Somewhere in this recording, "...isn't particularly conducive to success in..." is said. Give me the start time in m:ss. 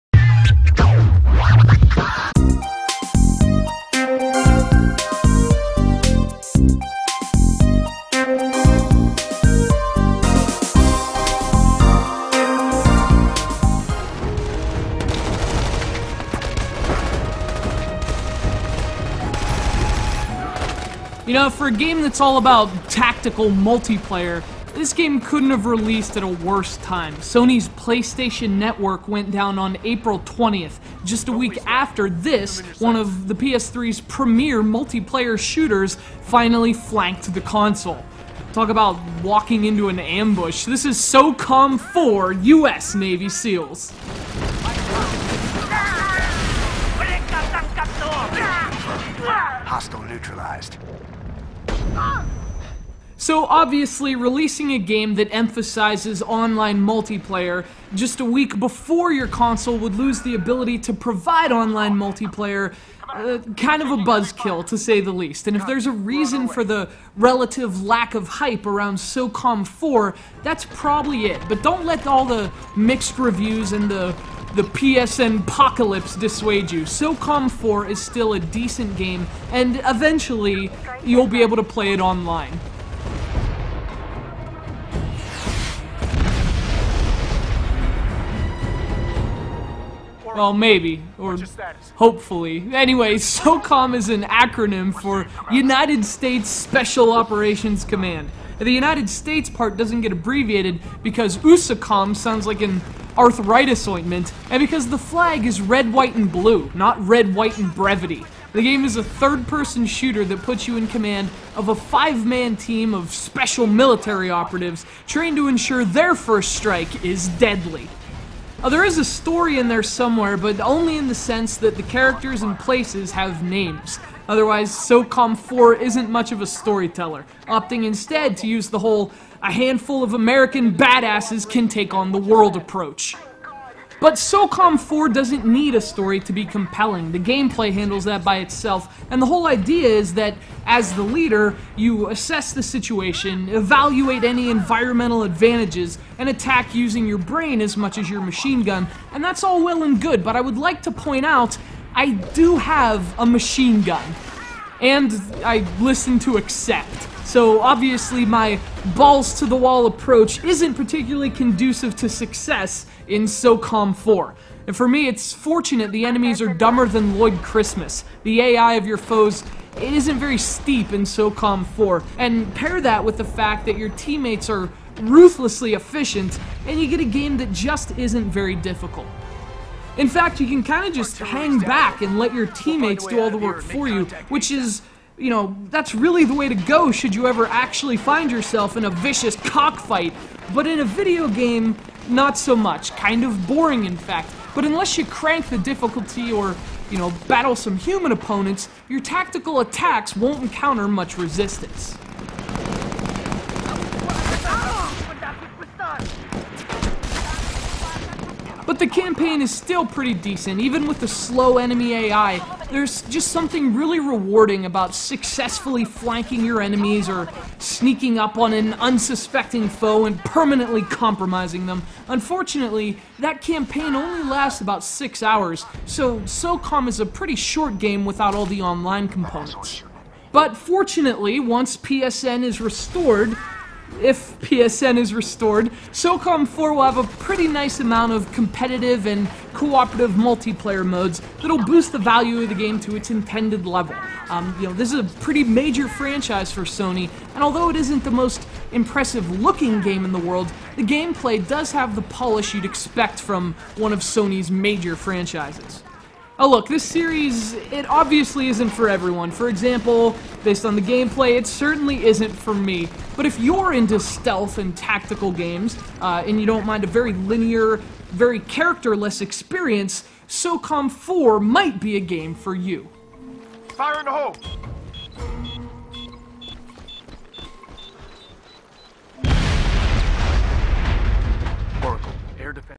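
2:40.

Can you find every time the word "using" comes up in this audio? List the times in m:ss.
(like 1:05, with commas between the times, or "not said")
2:26.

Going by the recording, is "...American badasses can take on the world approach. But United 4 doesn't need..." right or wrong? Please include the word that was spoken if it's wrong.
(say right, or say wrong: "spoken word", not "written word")
wrong: "SOCOM", not "United".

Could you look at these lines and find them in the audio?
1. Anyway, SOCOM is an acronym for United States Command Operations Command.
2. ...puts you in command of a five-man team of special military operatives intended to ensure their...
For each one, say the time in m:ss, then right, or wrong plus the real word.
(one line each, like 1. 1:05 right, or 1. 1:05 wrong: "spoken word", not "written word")
1. 1:32 wrong: "Special", not "Command"
2. 1:50 wrong: "trained", not "intended".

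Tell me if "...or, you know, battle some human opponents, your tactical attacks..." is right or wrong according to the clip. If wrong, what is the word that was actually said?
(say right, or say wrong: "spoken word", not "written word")
right.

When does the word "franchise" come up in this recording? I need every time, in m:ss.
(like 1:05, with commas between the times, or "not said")
4:05, 4:14.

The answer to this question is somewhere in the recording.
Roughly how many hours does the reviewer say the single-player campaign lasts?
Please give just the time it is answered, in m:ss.
3:44.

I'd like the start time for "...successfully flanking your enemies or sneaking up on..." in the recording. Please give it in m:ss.
3:34.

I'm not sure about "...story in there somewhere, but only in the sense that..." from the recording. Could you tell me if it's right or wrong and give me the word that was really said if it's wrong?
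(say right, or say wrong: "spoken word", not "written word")
right.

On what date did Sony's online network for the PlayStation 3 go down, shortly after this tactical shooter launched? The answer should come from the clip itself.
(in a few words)
April 20th.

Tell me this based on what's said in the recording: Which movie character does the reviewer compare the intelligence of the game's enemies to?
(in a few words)
Lloyd Christmas.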